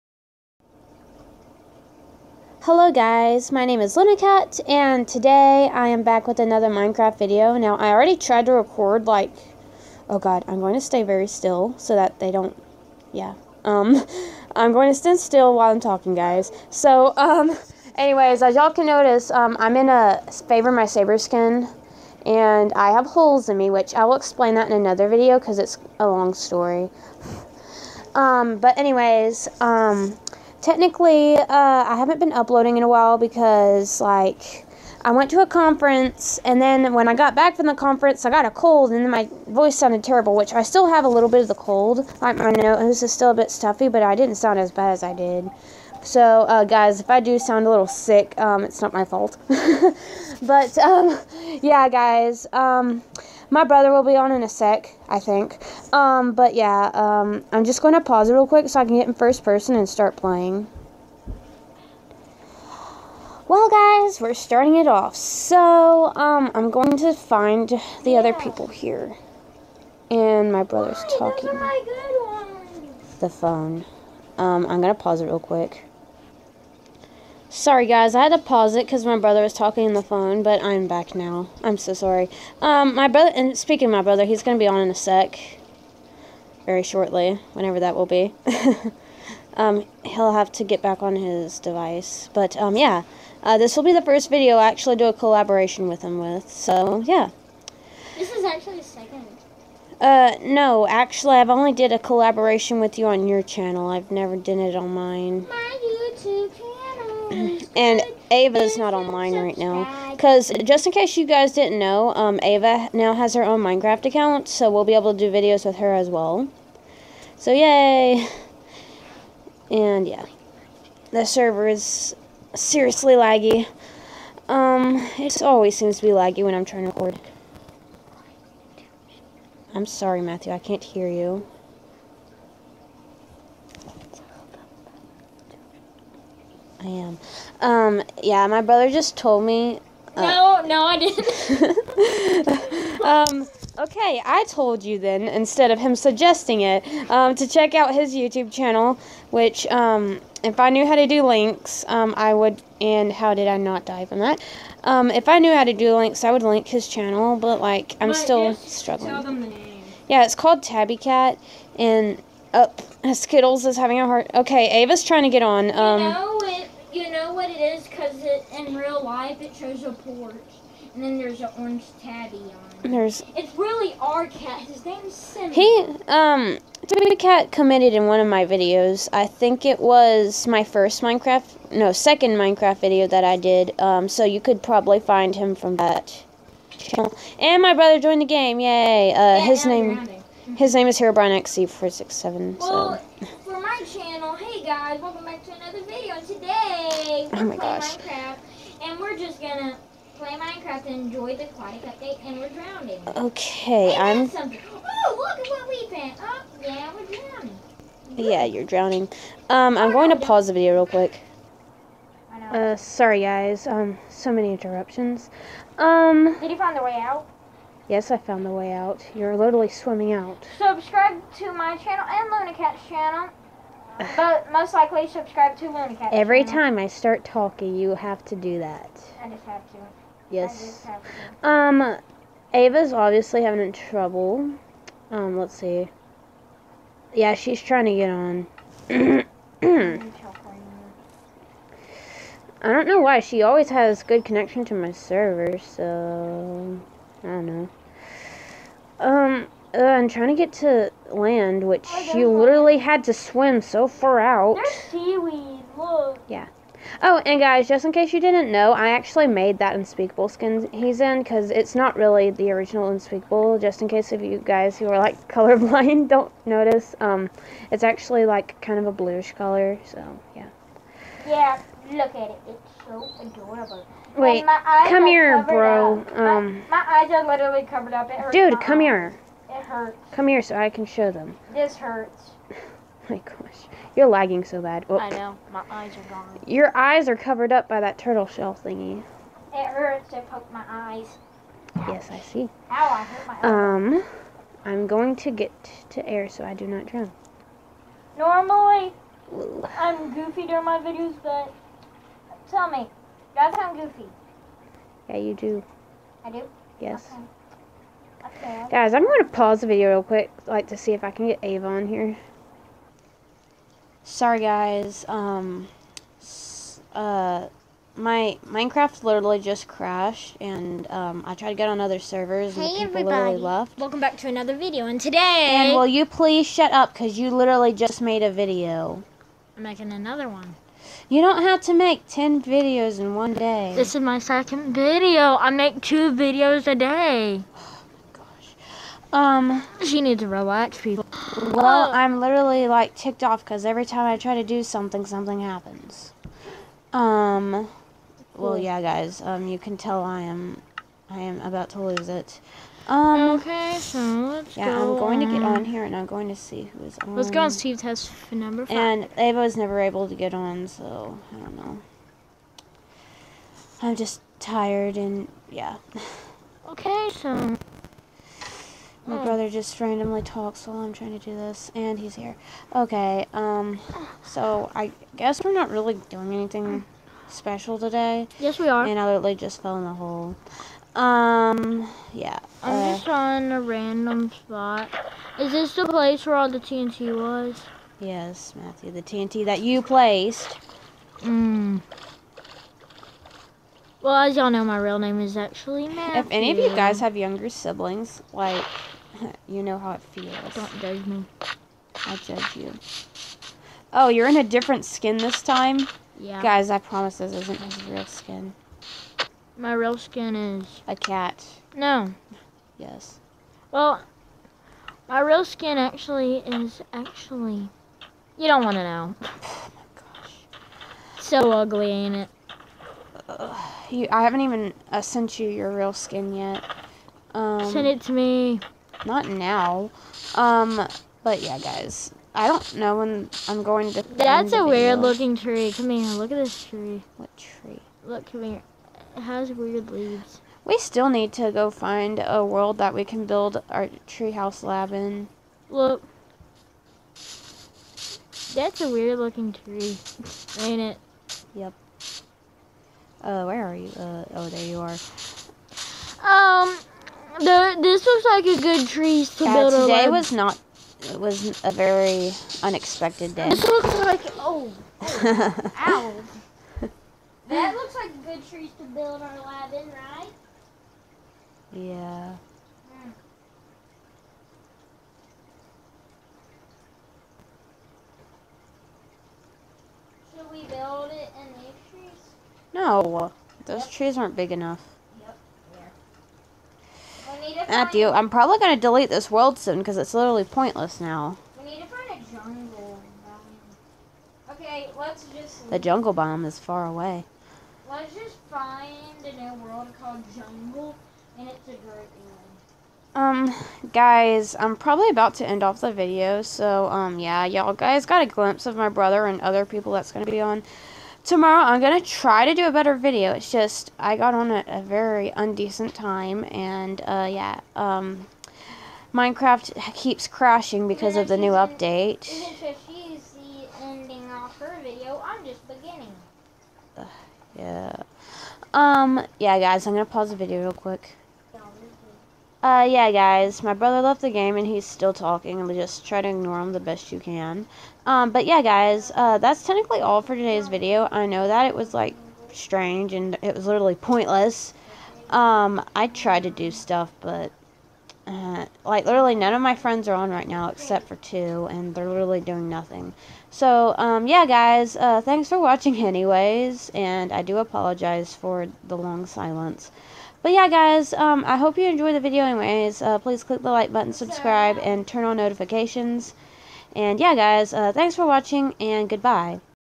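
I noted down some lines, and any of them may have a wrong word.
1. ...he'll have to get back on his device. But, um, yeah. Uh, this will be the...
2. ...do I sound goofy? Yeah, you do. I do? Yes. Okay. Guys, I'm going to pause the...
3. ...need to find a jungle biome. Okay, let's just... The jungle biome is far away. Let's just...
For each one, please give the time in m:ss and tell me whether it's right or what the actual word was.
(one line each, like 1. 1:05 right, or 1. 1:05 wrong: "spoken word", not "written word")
1. 1:30 right
2. 5:03 right
3. 8:11 right.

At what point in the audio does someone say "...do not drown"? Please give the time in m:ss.
4:56.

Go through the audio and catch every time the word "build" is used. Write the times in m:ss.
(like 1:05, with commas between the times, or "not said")
7:23, 7:39, 7:48, 8:00.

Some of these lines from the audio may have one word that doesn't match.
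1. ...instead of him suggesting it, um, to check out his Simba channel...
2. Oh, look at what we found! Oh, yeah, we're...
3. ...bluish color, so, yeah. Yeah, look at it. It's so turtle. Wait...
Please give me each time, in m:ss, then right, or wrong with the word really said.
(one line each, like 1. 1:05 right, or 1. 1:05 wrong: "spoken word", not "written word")
1. 2:25 wrong: "YouTube", not "Simba"
2. 3:24 right
3. 4:28 wrong: "adorable", not "turtle".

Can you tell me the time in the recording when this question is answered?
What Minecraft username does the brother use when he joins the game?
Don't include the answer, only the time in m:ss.
3:10.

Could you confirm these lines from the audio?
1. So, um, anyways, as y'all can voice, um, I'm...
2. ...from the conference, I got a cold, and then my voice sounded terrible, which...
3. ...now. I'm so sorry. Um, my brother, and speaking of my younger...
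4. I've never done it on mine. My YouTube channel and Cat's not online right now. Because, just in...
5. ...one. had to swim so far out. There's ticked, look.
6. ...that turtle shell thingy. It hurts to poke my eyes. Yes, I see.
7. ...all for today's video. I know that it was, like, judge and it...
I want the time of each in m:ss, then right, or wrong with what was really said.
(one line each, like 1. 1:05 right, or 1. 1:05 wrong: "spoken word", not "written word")
1. 0:16 wrong: "notice", not "voice"
2. 0:37 right
3. 1:21 wrong: "brother", not "younger"
4. 1:43 wrong: "Ava", not "Cat"
5. 4:12 wrong: "seaweed", not "ticked"
6. 4:47 right
7. 9:00 wrong: "strange", not "judge".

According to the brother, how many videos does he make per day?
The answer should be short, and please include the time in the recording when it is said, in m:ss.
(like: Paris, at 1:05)
2, at 5:35.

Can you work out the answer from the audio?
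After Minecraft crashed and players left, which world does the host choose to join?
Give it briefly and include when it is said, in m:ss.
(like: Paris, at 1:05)
Steve test for number five, at 5:57.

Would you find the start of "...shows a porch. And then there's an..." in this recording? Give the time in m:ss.
2:49.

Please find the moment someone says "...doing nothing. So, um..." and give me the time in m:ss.
9:12.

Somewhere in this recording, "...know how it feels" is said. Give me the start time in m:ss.
6:39.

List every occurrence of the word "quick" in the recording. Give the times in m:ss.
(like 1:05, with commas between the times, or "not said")
0:58, 1:15, 3:30, 5:10, 8:50.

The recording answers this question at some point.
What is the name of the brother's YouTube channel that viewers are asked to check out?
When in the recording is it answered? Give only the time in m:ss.
2:40.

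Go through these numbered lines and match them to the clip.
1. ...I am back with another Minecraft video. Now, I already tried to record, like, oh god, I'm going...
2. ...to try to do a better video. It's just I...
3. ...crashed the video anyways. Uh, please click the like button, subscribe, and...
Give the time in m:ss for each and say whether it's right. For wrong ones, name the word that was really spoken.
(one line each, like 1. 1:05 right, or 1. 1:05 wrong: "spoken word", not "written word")
1. 0:05 right
2. 8:32 right
3. 9:21 wrong: "enjoyed", not "crashed".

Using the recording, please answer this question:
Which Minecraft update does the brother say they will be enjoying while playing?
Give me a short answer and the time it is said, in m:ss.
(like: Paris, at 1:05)
aquatic update, at 3:21.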